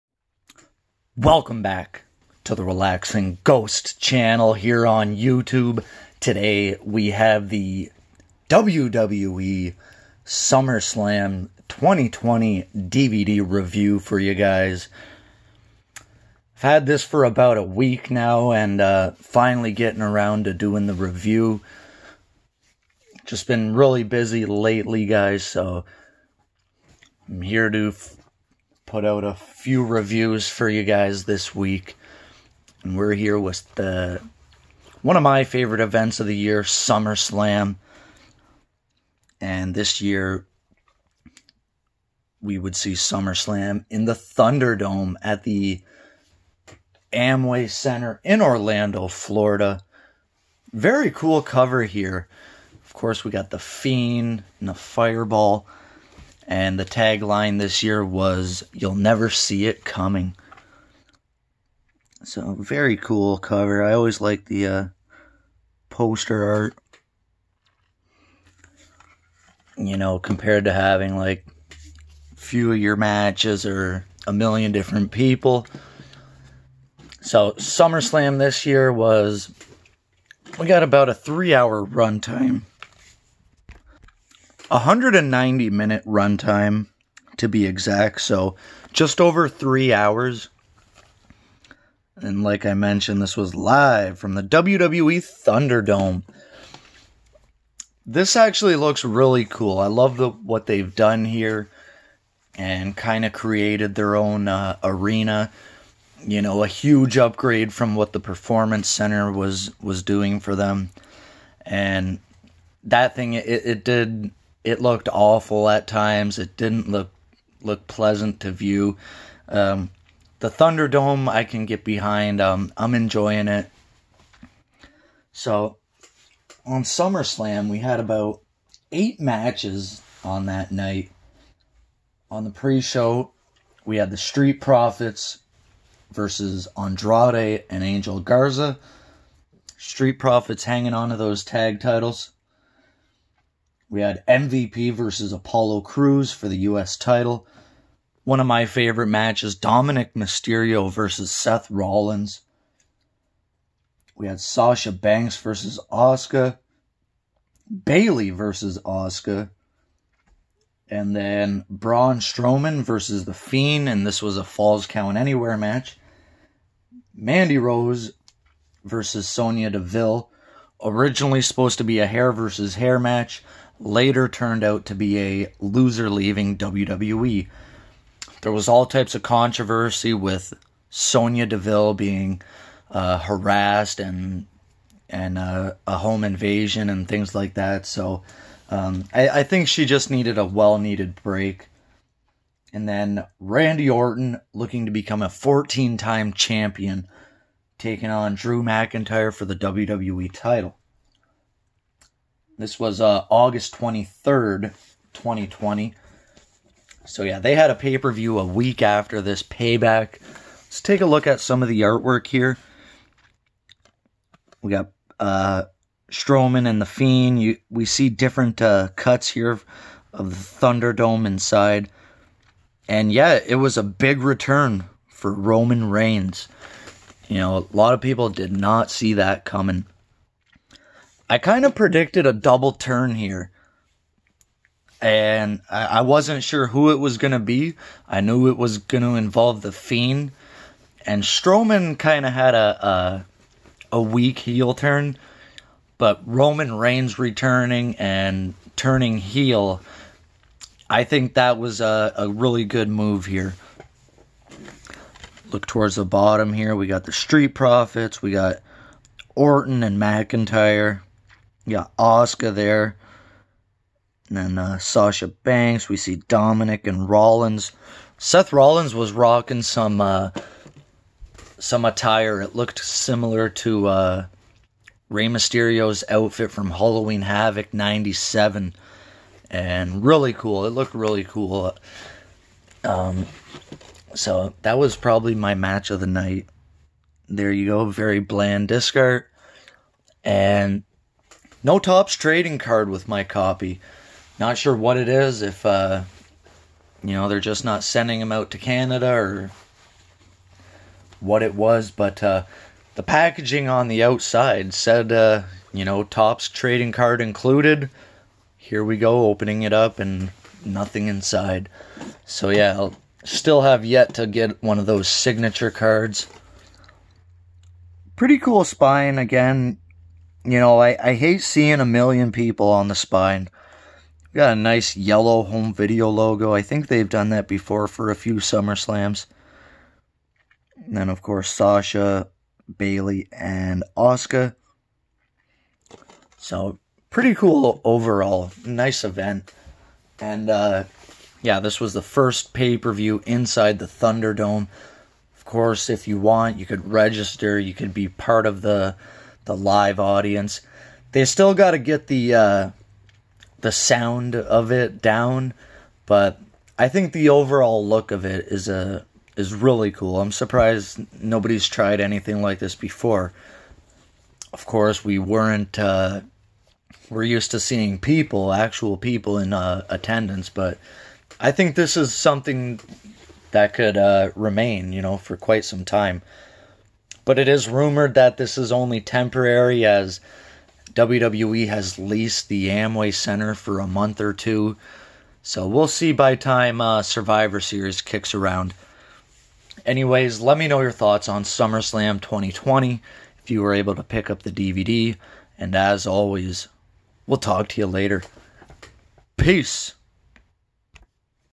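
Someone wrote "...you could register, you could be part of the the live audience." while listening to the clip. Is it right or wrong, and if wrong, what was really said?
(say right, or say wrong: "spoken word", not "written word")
right.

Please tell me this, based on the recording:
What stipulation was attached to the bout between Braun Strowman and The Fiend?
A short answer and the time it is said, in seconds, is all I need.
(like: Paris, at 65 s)
Falls Count Anywhere, at 164 s.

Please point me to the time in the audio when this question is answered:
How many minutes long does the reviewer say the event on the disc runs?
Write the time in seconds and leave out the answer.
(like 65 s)
84 s.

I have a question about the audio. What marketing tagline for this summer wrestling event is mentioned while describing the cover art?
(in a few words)
You'll Never See It Coming.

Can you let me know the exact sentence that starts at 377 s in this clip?
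But it is rumored that this is only temporary as WWE has leased the Amway Center for a month or two.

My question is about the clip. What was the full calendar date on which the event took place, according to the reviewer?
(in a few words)
August 23rd, 2020.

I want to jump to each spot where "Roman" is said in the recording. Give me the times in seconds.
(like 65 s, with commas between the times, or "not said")
225 s, 246 s.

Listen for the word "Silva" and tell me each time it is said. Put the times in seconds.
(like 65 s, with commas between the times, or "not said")
not said.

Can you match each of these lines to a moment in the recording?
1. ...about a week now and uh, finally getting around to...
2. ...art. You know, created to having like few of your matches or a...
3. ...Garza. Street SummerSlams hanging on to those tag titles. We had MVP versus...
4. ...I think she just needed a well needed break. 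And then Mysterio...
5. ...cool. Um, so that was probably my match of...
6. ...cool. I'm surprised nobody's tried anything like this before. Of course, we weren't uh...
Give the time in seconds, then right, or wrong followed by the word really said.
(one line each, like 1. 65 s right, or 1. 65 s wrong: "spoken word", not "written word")
1. 17 s right
2. 66 s wrong: "compared", not "created"
3. 138 s wrong: "Profits", not "SummerSlams"
4. 189 s wrong: "Randy", not "Mysterio"
5. 281 s right
6. 359 s right.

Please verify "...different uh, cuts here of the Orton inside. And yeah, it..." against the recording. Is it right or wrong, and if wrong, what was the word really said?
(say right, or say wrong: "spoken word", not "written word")
wrong: "Thunderdome", not "Orton".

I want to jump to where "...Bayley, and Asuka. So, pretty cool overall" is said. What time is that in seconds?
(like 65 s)
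332 s.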